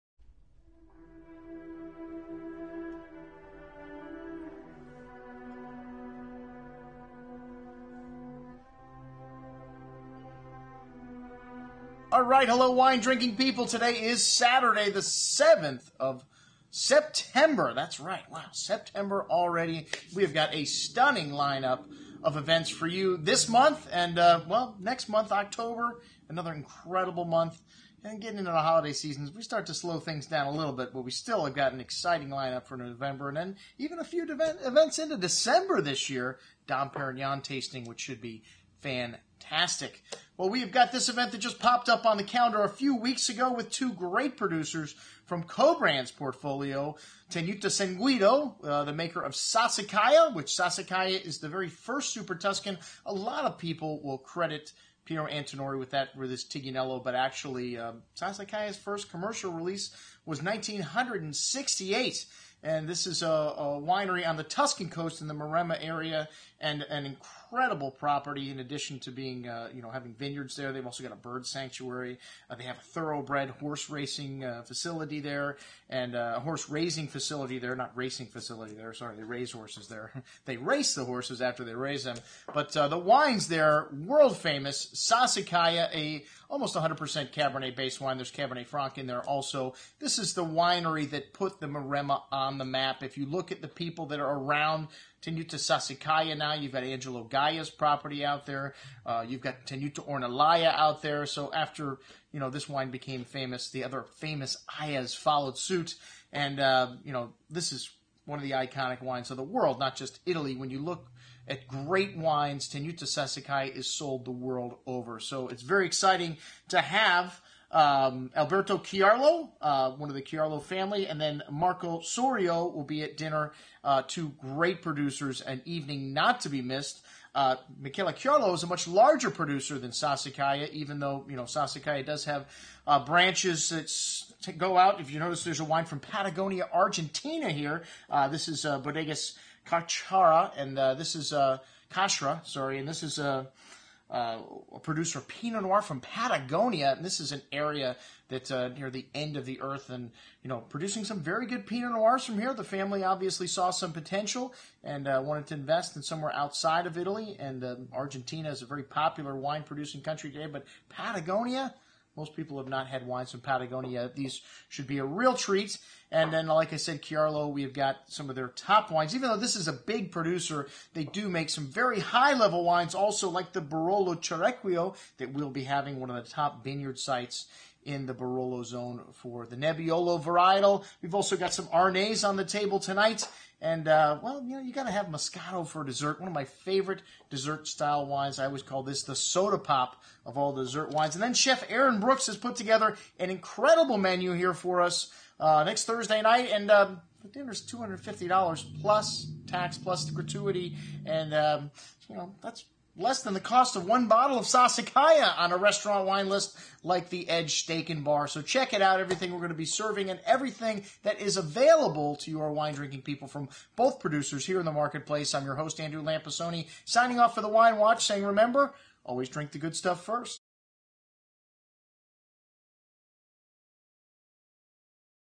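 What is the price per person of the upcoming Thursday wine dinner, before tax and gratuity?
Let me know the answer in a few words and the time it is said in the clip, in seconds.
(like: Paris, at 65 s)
$250, at 197 s.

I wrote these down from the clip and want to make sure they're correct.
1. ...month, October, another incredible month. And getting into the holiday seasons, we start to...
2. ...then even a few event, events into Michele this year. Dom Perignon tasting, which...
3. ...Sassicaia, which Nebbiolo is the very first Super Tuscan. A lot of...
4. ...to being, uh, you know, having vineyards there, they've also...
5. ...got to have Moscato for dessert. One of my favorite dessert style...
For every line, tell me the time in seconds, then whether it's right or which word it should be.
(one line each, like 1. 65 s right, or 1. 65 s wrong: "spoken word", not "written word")
1. 25 s right
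2. 33 s wrong: "December", not "Michele"
3. 49 s wrong: "Sassicaia", not "Nebbiolo"
4. 68 s right
5. 184 s right.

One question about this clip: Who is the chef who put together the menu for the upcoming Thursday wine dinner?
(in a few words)
Aaron Brooks.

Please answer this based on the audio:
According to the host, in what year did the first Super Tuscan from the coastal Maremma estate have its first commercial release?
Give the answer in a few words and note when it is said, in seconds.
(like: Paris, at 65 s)
1968, at 60 s.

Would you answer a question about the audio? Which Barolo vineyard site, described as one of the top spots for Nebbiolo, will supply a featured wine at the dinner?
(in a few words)
Cerequio.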